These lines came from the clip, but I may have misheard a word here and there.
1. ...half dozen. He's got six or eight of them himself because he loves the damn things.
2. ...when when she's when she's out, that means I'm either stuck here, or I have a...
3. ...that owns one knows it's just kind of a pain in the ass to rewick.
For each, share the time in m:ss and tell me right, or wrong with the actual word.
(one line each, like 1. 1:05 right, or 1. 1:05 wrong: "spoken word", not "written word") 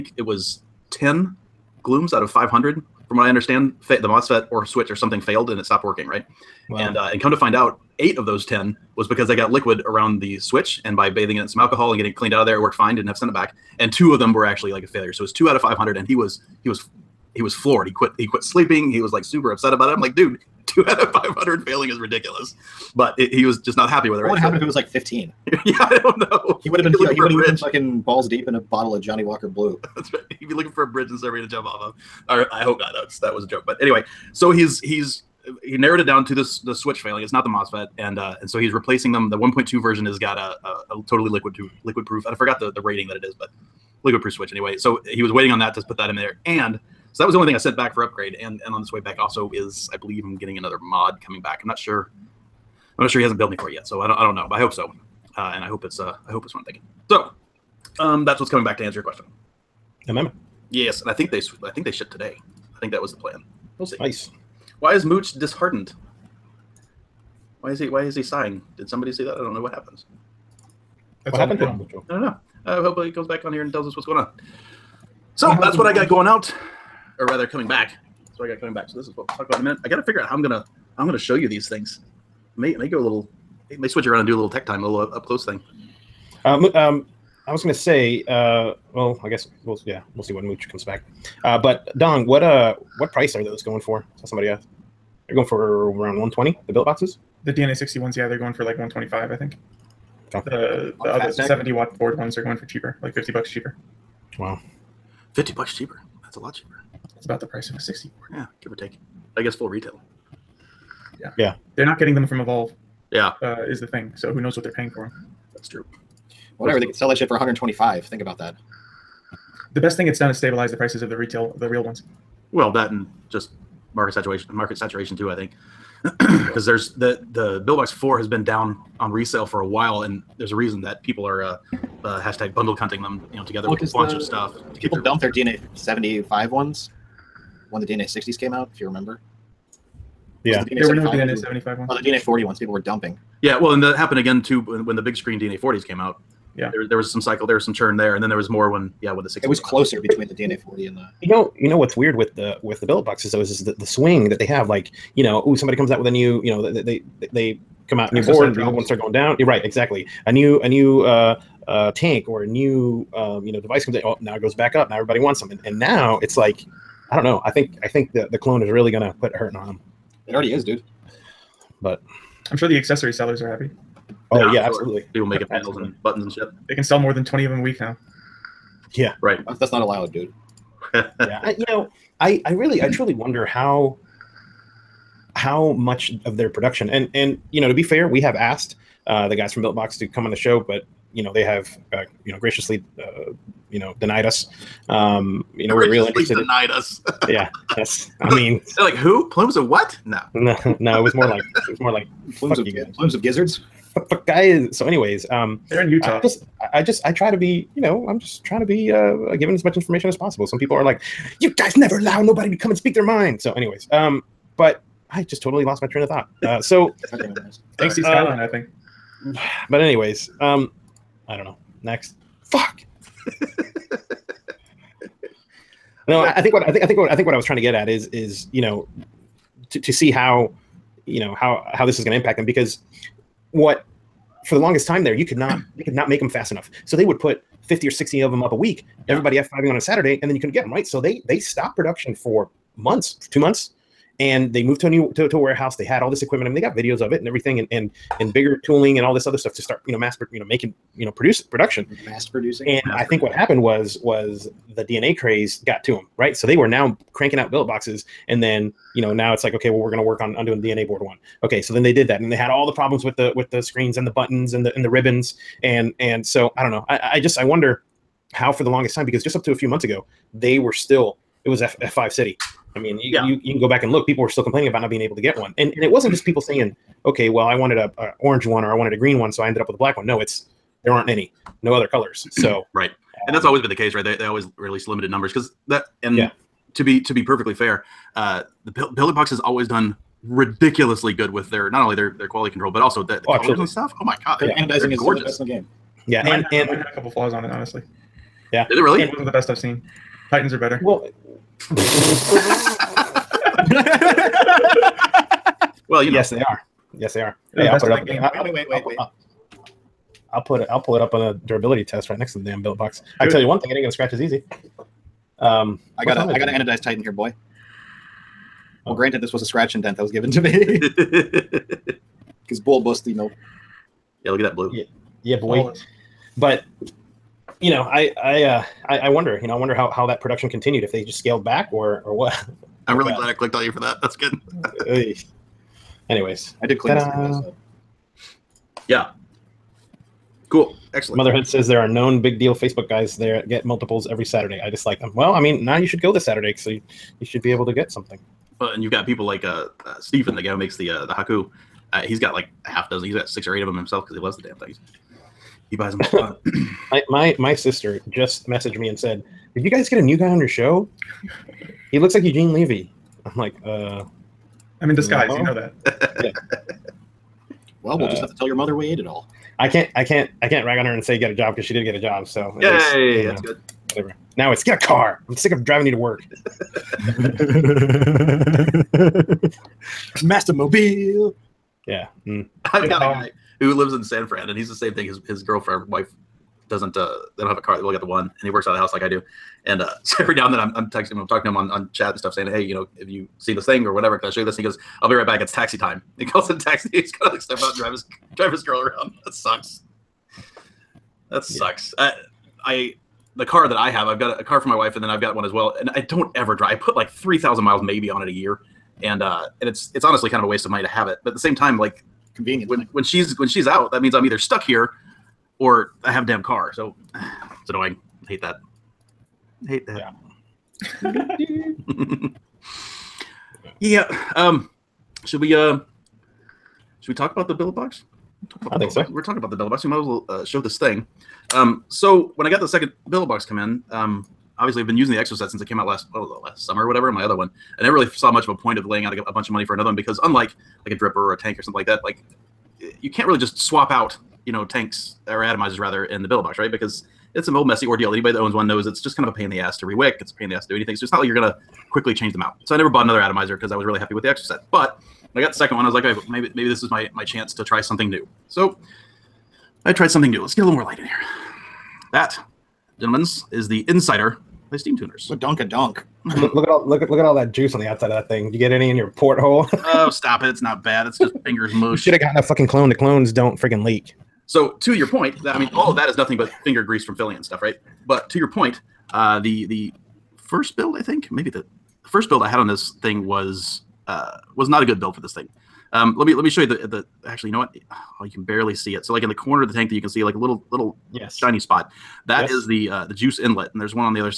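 1. 5:52 right
2. 6:52 right
3. 7:28 right.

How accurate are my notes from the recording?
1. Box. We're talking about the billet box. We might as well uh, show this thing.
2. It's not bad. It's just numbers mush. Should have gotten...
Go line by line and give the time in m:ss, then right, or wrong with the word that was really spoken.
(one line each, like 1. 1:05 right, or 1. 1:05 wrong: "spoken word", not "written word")
1. 7:09 right
2. 7:50 wrong: "fingers", not "numbers".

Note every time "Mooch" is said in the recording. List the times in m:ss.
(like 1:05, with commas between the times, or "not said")
1:05, 1:30.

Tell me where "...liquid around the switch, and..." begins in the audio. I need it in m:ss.
0:09.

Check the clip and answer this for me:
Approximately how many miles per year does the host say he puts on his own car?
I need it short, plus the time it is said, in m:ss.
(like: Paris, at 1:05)
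3000, at 6:47.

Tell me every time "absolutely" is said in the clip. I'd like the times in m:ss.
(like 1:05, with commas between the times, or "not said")
2:54, 4:53.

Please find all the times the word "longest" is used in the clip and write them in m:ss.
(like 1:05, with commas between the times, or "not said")
3:54, 4:28.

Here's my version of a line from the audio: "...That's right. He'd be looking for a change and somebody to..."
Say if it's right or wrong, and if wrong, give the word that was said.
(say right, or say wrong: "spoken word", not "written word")
wrong: "bridge", not "change".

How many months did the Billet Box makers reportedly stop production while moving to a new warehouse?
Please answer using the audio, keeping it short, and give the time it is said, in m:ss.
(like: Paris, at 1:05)
2, at 4:03.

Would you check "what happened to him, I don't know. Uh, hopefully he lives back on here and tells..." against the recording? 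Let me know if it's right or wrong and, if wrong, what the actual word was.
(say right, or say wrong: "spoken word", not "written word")
wrong: "comes", not "lives".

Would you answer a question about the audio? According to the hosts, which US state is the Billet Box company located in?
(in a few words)
Utah.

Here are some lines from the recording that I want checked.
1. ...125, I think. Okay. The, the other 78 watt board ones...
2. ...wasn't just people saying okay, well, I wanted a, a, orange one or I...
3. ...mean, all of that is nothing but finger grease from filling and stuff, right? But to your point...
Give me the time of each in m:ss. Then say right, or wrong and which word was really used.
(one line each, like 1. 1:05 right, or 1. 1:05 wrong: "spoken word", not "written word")
1. 1:38 wrong: "70", not "78"
2. 4:35 right
3. 7:55 right.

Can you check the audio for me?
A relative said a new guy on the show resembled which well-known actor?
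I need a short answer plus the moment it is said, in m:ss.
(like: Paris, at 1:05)
Eugene Levy, at 6:02.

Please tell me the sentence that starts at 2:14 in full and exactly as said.
people their dump their DNA 75 ones when the DNA 60s came out, if you remember.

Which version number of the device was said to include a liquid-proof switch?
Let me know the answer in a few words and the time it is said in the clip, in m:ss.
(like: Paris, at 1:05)
1.2, at 0:39.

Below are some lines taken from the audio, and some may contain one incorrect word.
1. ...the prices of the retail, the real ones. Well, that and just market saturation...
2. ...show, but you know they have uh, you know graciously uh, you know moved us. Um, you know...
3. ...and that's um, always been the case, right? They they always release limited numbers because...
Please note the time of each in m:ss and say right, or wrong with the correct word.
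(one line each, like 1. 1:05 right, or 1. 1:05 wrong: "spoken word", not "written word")
1. 2:00 right
2. 3:10 wrong: "denied", not "moved"
3. 4:43 right.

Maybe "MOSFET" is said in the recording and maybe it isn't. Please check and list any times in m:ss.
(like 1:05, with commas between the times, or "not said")
0:04, 0:37.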